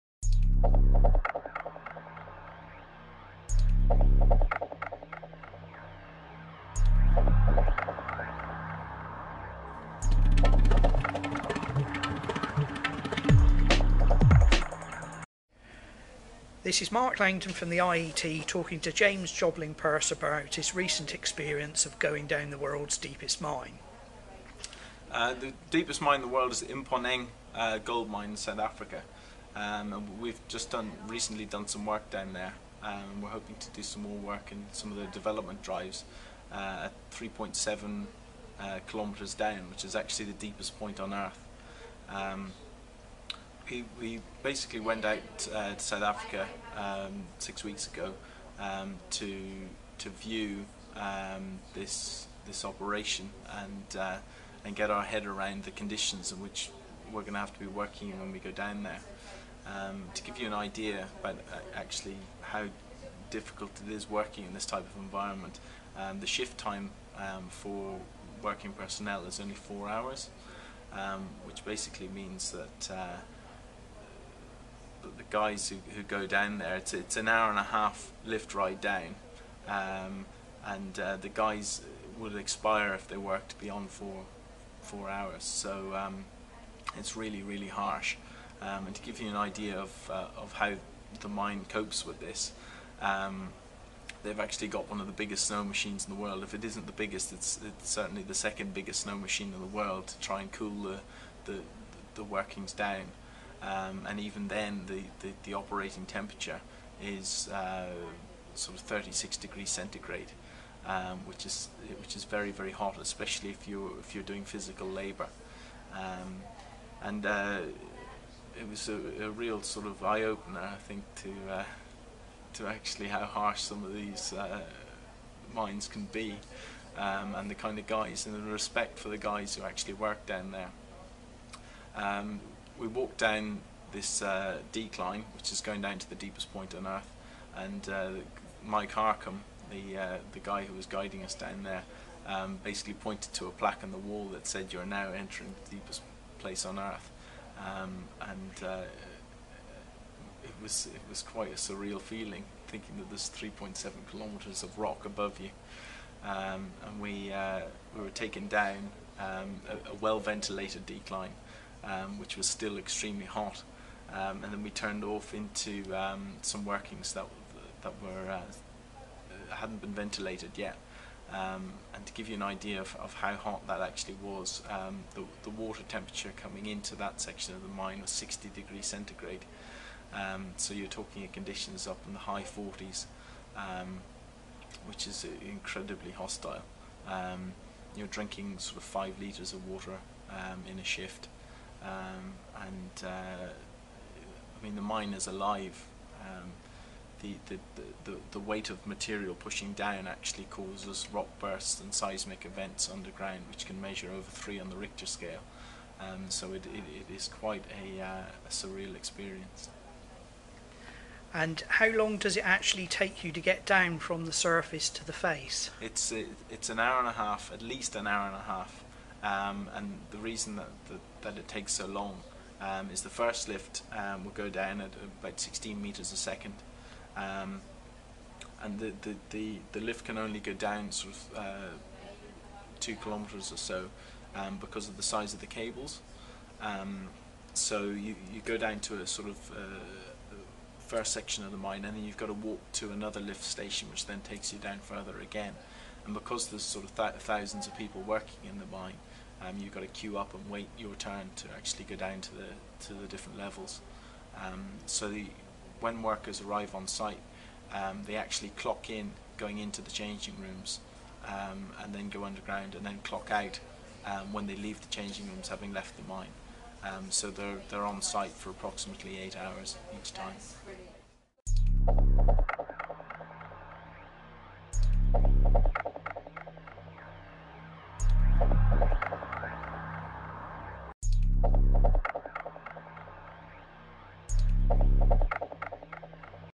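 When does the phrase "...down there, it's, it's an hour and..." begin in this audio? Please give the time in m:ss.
1:16.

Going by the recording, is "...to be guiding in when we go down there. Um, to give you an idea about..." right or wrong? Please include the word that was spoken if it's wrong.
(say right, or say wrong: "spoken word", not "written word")
wrong: "working", not "guiding".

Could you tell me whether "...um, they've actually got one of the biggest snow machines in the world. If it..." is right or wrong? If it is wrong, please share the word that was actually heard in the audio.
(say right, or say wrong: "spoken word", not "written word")
right.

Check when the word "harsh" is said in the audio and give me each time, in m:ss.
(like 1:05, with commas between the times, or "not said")
1:27, 2:03.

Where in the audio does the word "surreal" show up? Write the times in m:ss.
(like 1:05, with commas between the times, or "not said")
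2:31, 3:28.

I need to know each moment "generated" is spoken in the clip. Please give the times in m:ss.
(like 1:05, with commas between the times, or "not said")
not said.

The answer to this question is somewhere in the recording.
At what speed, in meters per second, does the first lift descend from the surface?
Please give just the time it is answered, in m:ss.
3:45.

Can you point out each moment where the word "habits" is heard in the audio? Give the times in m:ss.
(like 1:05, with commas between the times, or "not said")
not said.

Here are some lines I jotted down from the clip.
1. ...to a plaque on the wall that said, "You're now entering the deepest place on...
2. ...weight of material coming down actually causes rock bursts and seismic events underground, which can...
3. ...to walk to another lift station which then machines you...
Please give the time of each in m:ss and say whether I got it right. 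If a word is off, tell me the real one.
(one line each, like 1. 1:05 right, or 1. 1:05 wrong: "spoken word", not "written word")
1. 2:23 right
2. 3:18 wrong: "pushing", not "coming"
3. 4:02 wrong: "takes", not "machines".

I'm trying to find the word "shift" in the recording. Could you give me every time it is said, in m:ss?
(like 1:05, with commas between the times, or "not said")
1:06, 3:10.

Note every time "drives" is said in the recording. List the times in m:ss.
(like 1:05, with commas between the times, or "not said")
0:35.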